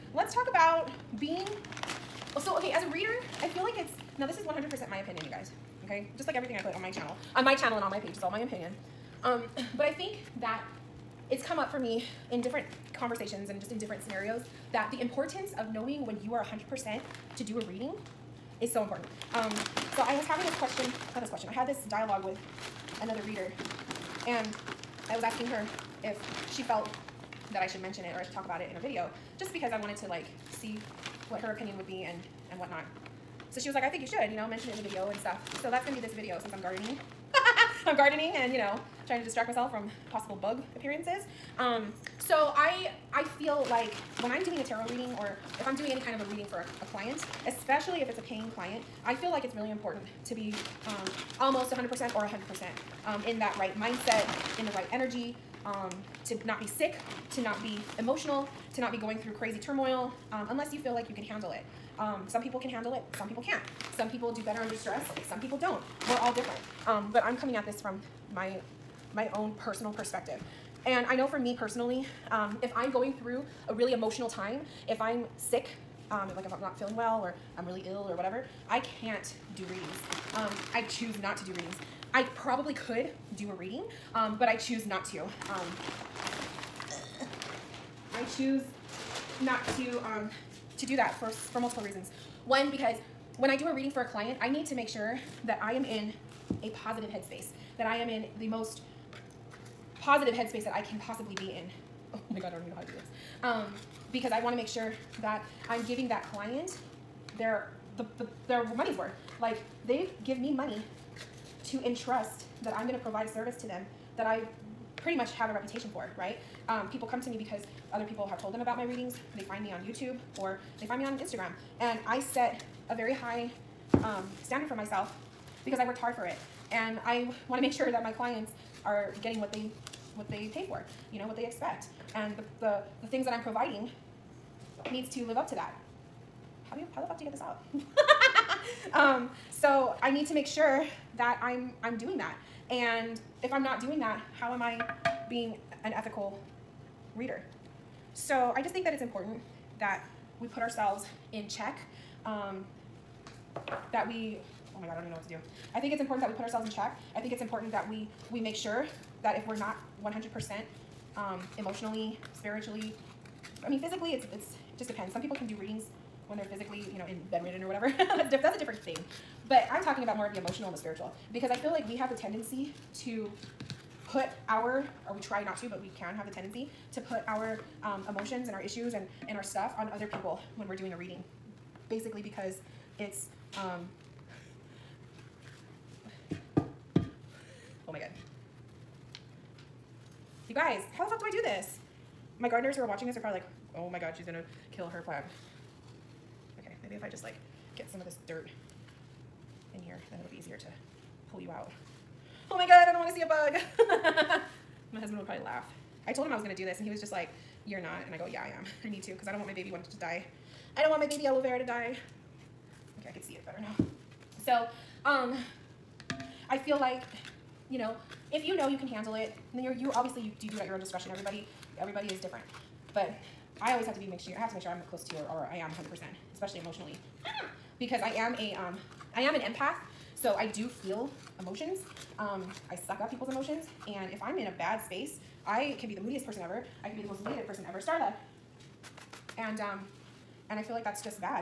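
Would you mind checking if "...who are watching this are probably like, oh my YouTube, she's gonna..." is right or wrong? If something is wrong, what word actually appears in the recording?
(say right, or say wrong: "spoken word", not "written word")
wrong: "God", not "YouTube".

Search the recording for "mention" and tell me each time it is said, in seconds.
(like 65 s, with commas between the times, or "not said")
27 s, 34 s.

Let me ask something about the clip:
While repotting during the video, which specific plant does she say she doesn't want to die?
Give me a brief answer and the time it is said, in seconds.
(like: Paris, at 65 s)
aloe vera, at 211 s.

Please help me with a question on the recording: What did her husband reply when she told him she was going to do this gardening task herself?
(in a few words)
you're not.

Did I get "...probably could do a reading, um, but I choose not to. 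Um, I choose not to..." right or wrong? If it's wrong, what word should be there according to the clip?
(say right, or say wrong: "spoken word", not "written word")
right.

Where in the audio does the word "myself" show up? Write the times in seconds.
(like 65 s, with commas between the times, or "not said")
39 s, 124 s.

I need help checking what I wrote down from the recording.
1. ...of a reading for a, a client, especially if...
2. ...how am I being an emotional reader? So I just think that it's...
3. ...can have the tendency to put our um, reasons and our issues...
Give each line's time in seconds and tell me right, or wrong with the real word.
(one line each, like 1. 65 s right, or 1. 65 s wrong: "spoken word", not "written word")
1. 46 s right
2. 144 s wrong: "ethical", not "emotional"
3. 175 s wrong: "emotions", not "reasons".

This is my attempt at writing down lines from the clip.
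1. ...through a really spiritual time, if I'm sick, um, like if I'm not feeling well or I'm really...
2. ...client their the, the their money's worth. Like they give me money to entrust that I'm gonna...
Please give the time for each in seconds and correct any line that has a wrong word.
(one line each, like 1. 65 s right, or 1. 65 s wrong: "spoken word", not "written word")
1. 73 s wrong: "emotional", not "spiritual"
2. 106 s right.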